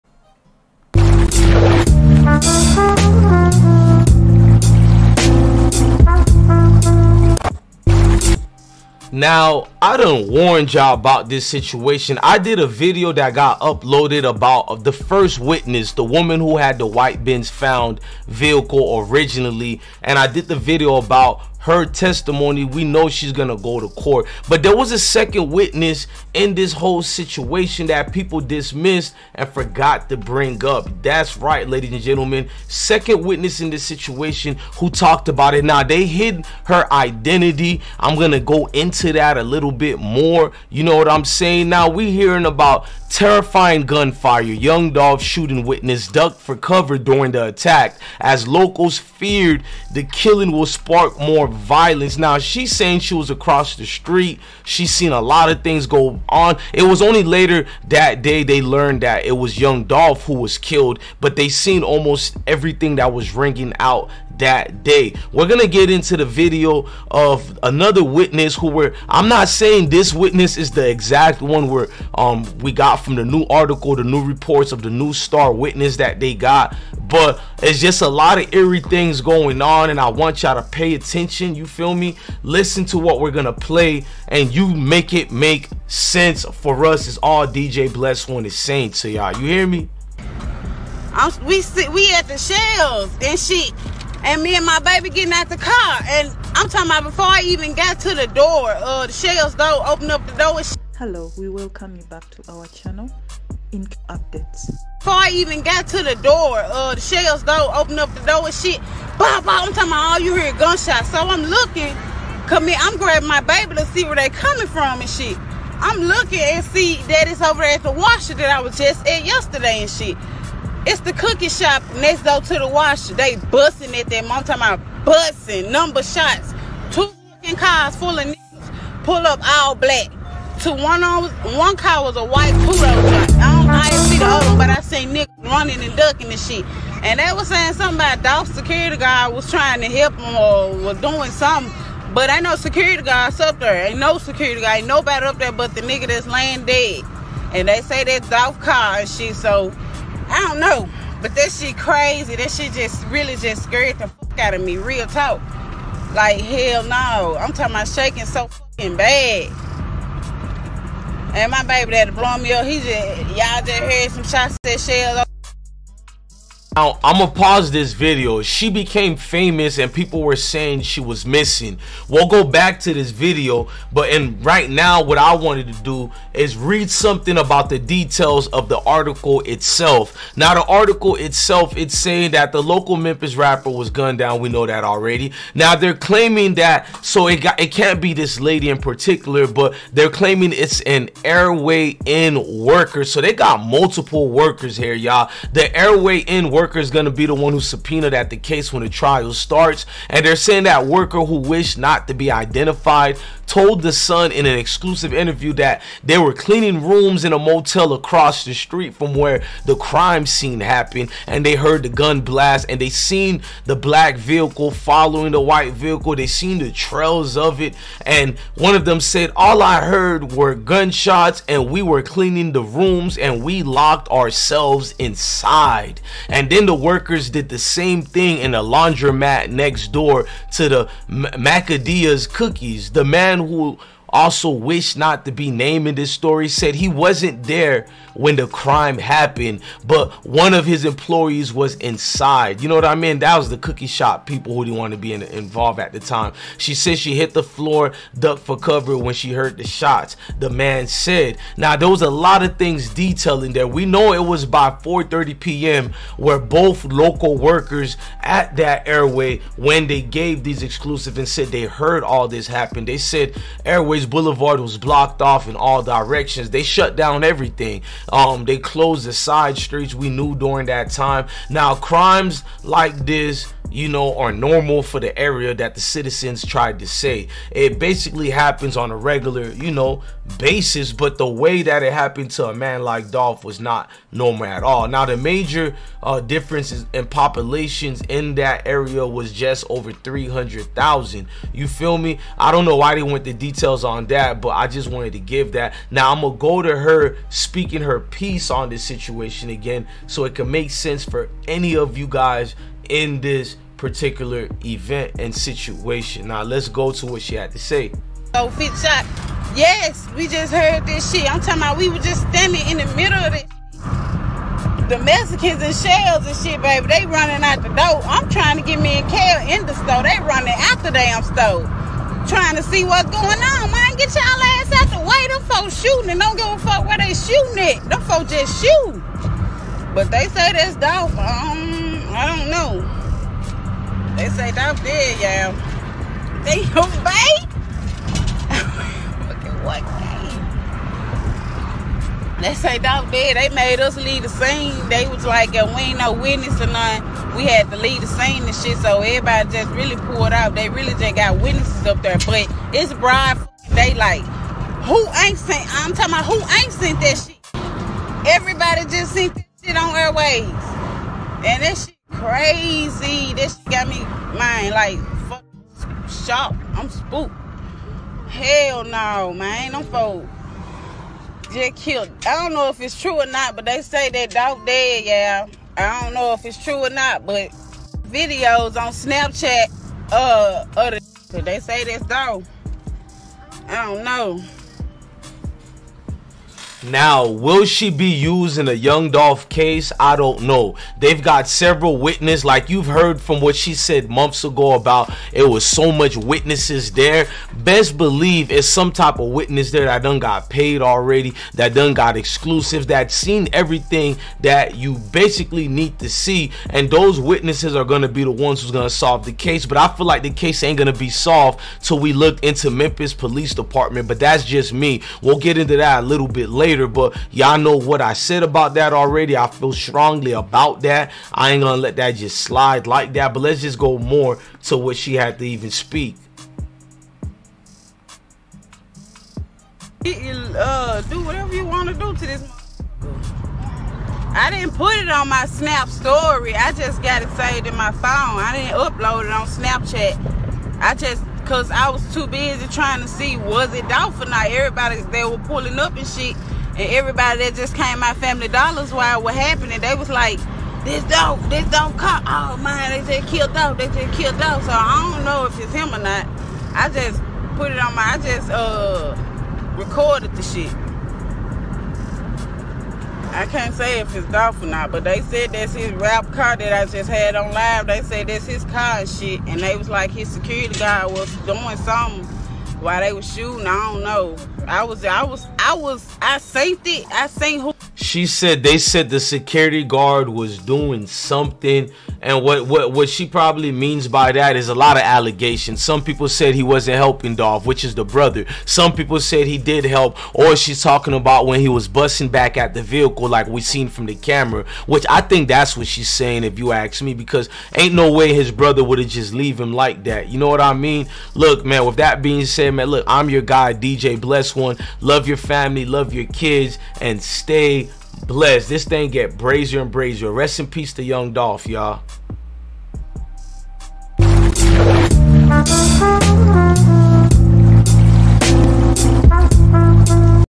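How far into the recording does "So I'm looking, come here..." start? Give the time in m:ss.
1:51.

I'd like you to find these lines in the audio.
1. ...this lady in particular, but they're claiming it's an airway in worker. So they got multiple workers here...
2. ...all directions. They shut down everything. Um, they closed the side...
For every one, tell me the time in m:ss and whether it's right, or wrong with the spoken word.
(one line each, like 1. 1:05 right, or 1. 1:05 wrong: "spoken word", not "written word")
1. 3:08 right
2. 4:25 right.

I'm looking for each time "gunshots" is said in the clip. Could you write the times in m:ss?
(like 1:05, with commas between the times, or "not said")
1:50, 3:40.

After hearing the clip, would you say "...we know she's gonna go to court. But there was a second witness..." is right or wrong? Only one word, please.
right.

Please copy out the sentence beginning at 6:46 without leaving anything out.
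And those witnesses are gonna be the ones who's gonna solve the case.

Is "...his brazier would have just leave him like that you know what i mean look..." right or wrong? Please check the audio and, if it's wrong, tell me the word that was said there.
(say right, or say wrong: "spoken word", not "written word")
wrong: "brother", not "brazier".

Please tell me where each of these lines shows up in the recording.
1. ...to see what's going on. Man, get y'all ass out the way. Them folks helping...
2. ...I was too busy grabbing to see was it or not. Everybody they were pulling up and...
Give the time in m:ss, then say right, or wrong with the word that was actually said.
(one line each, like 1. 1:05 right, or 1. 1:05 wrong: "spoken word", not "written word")
1. 5:22 wrong: "shooting", not "helping"
2. 7:21 wrong: "trying", not "grabbing".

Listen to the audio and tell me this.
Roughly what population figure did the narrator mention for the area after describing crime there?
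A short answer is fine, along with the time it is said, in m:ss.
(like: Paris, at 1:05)
Just over 300,000, at 4:49.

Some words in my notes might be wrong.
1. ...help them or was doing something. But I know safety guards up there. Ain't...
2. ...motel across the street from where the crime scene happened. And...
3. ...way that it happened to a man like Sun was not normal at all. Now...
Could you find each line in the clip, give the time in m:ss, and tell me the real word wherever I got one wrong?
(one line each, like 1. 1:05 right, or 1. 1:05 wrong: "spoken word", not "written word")
1. 2:19 wrong: "security", not "safety"
2. 3:27 right
3. 4:41 wrong: "Dolph", not "Sun".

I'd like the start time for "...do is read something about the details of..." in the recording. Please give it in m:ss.
2:55.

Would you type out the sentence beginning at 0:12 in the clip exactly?
I did a video that got uploaded about uh, the first witness, the woman who had the white bins found vehicle originally.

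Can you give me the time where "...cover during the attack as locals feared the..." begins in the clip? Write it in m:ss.
0:46.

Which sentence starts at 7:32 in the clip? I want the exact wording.
Oh man, they said killed dog, they said killed dog.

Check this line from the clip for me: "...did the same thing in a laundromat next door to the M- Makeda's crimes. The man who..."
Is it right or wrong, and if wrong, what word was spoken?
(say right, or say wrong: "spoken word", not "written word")
wrong: "cookies", not "crimes".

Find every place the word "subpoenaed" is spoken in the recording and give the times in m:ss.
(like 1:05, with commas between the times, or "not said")
3:17.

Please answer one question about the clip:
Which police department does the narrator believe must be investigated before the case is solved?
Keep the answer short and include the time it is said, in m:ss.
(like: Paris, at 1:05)
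Memphis Police Department, at 6:52.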